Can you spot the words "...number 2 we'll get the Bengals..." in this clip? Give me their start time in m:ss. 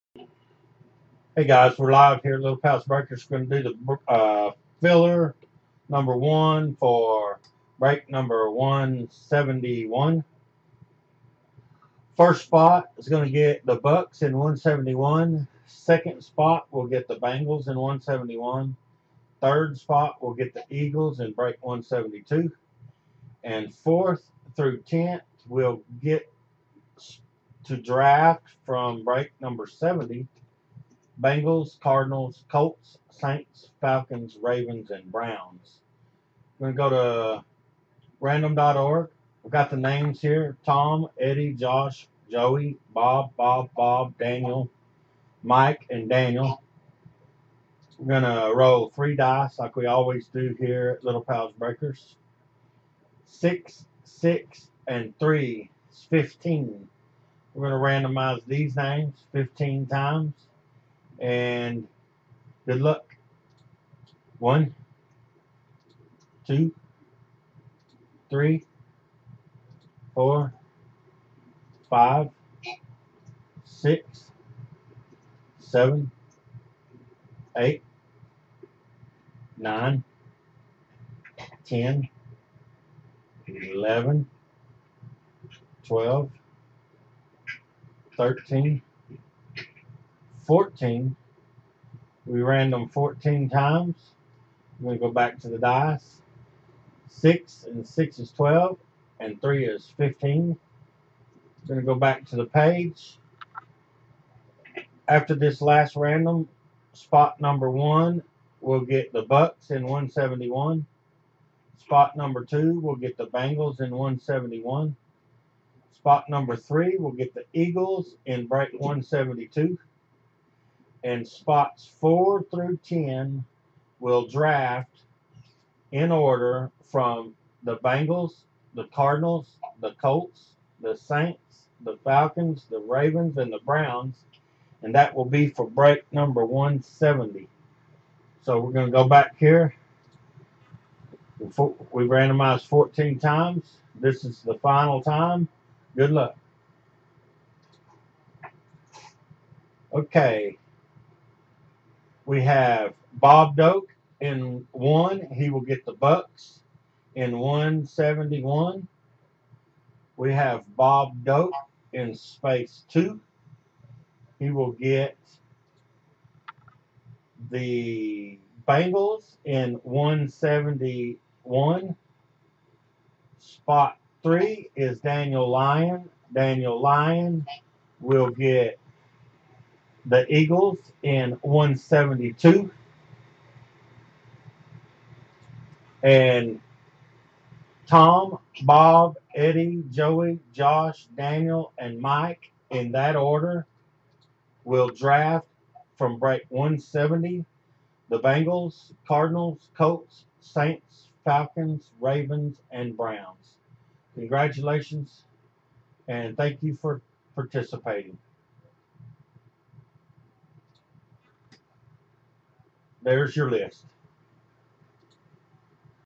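1:52.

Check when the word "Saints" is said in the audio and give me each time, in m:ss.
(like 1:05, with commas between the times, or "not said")
0:33, 2:10, 3:20.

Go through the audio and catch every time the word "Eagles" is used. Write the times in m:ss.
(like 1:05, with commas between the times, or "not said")
0:20, 1:57, 3:00.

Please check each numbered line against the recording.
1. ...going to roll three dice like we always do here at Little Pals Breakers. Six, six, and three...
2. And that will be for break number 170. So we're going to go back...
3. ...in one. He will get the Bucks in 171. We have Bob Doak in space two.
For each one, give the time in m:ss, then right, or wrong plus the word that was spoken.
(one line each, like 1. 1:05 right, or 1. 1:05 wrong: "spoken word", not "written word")
1. 0:48 right
2. 2:14 right
3. 2:34 right.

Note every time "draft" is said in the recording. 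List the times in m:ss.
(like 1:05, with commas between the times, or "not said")
0:27, 2:04, 3:14.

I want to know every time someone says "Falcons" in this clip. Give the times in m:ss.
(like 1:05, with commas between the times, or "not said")
0:33, 2:12, 3:21.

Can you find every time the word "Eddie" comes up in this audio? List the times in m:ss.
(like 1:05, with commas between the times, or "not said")
0:41, 3:09.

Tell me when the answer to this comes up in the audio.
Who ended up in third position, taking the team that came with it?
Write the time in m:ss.
2:53.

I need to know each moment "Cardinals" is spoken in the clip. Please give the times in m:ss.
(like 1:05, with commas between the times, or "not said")
0:31, 2:08, 3:19.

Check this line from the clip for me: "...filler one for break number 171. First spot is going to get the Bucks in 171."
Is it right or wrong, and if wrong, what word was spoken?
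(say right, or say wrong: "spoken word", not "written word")
wrong: "number", not "filler".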